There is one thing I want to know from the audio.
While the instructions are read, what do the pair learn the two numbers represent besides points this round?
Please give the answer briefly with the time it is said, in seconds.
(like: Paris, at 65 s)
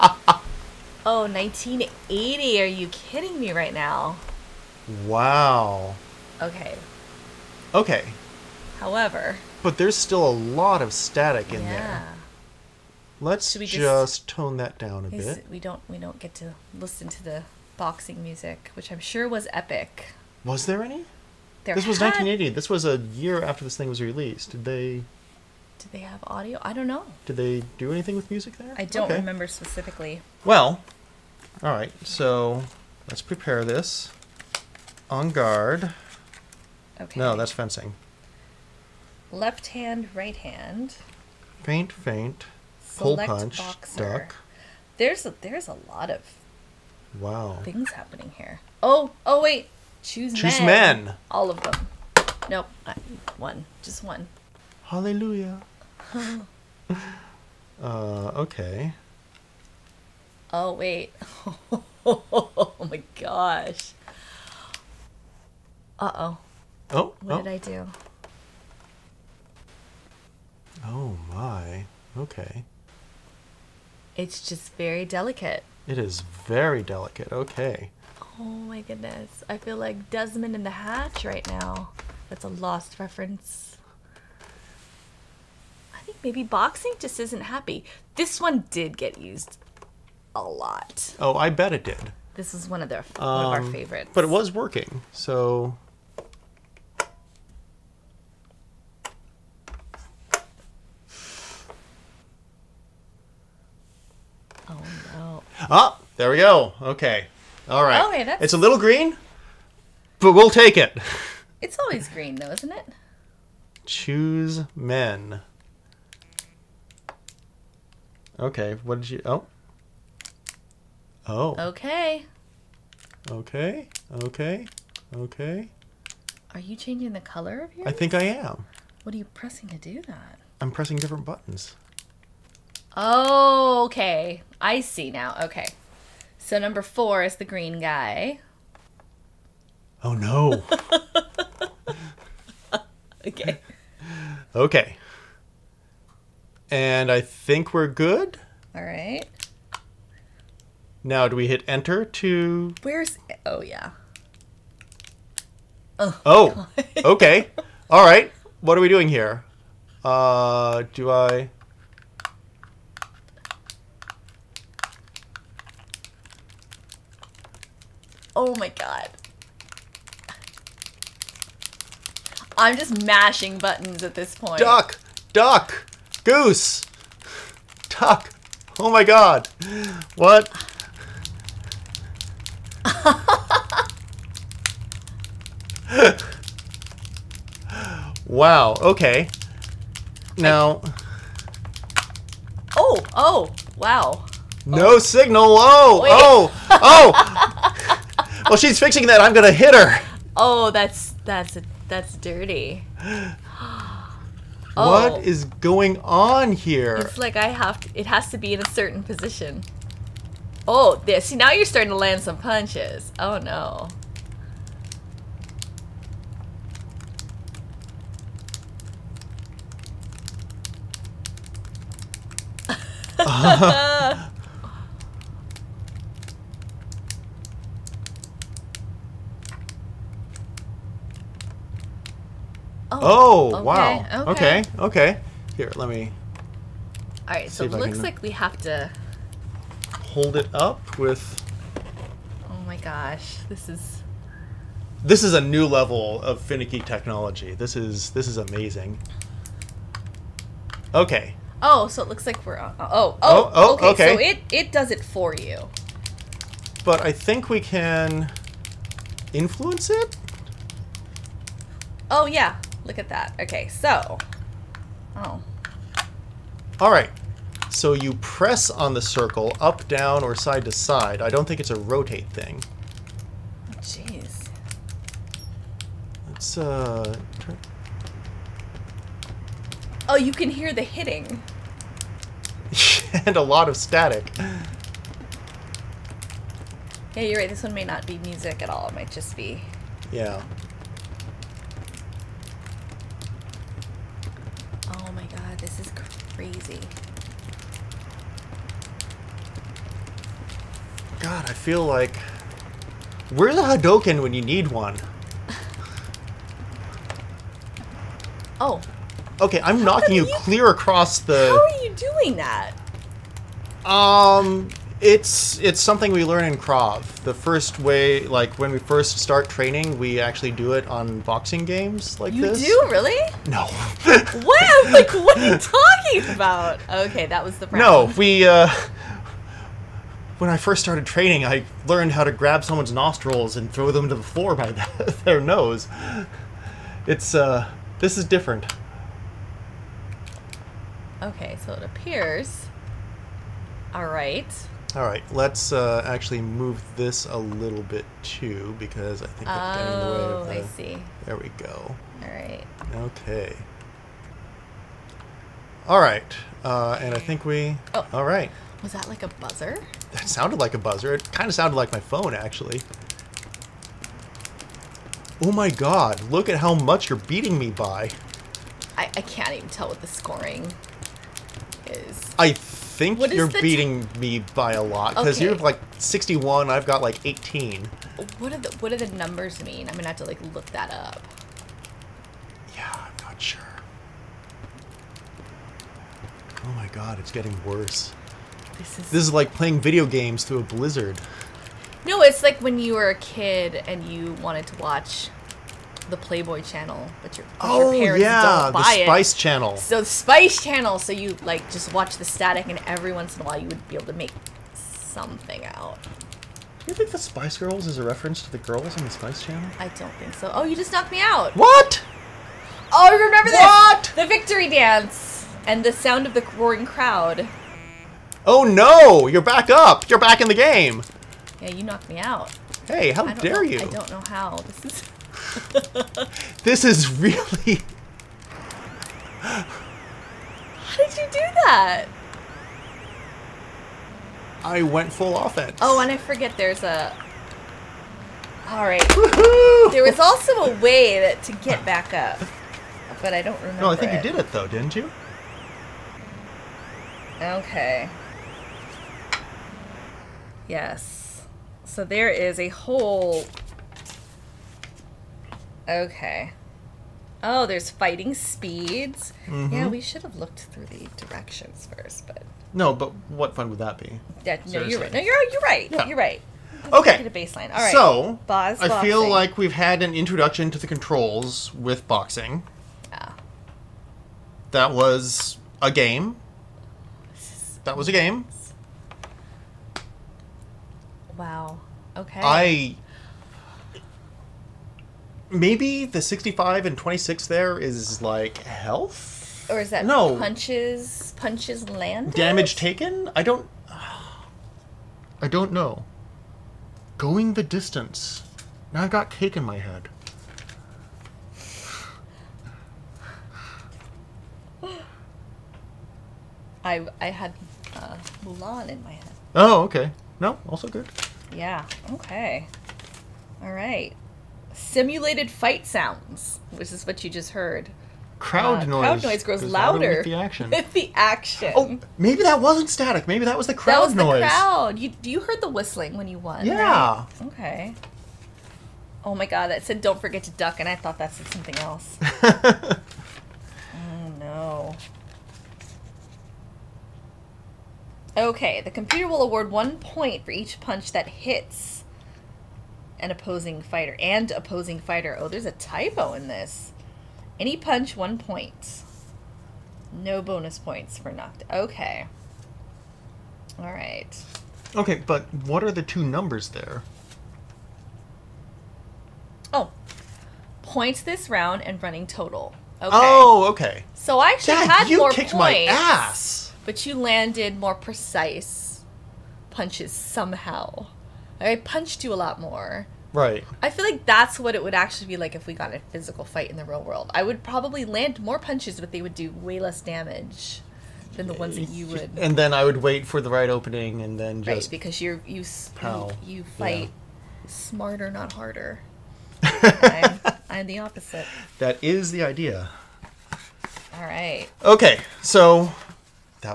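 running total, at 562 s.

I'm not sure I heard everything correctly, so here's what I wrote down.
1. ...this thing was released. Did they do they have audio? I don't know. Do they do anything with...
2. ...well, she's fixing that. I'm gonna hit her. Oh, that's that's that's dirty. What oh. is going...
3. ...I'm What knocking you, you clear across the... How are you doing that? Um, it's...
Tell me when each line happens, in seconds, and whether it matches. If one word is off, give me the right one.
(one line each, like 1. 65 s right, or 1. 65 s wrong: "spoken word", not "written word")
1. 23 s right
2. 198 s right
3. 309 s wrong: "How", not "What".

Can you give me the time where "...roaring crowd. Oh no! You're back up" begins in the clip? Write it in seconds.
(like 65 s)
416 s.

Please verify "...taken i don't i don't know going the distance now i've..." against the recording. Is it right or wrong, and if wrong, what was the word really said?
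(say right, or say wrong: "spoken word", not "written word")
right.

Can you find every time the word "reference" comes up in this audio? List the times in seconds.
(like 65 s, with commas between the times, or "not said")
82 s, 408 s.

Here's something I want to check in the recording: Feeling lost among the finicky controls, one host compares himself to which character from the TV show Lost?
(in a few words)
Desmond.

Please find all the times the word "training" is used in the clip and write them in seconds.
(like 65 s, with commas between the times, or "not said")
319 s, 331 s.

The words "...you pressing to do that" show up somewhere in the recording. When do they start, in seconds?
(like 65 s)
129 s.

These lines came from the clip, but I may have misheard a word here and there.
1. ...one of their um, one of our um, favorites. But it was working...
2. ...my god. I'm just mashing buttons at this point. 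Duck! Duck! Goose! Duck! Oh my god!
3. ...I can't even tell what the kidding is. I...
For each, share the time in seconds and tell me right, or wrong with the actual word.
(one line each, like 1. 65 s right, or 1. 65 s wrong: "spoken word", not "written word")
1. 92 s right
2. 168 s right
3. 369 s wrong: "scoring", not "kidding".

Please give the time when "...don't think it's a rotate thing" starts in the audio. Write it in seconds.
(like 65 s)
271 s.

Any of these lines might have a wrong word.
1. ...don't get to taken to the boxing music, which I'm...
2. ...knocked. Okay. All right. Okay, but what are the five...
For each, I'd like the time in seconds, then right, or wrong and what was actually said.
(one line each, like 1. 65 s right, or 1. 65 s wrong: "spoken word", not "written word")
1. 15 s wrong: "listen", not "taken"
2. 551 s wrong: "two", not "five".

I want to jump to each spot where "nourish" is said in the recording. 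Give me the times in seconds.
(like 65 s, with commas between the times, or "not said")
not said.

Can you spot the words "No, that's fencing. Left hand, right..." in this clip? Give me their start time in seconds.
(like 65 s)
37 s.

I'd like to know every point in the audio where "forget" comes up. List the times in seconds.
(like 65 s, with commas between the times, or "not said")
436 s, 530 s.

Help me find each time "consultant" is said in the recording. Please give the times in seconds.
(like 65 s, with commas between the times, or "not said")
not said.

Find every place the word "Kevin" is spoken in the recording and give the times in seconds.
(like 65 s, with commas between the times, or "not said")
not said.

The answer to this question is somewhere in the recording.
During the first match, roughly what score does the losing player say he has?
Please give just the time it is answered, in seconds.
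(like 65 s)
377 s.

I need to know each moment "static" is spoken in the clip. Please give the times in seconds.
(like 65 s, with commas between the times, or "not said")
10 s, 283 s, 402 s, 522 s.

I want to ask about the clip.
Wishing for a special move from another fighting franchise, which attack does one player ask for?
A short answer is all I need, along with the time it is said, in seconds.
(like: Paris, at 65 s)
Hadoken, at 303 s.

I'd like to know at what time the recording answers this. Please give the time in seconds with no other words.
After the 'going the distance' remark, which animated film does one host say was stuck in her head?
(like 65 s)
508 s.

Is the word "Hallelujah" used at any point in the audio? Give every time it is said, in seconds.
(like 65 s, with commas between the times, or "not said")
54 s.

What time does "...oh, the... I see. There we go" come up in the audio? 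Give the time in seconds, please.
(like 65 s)
350 s.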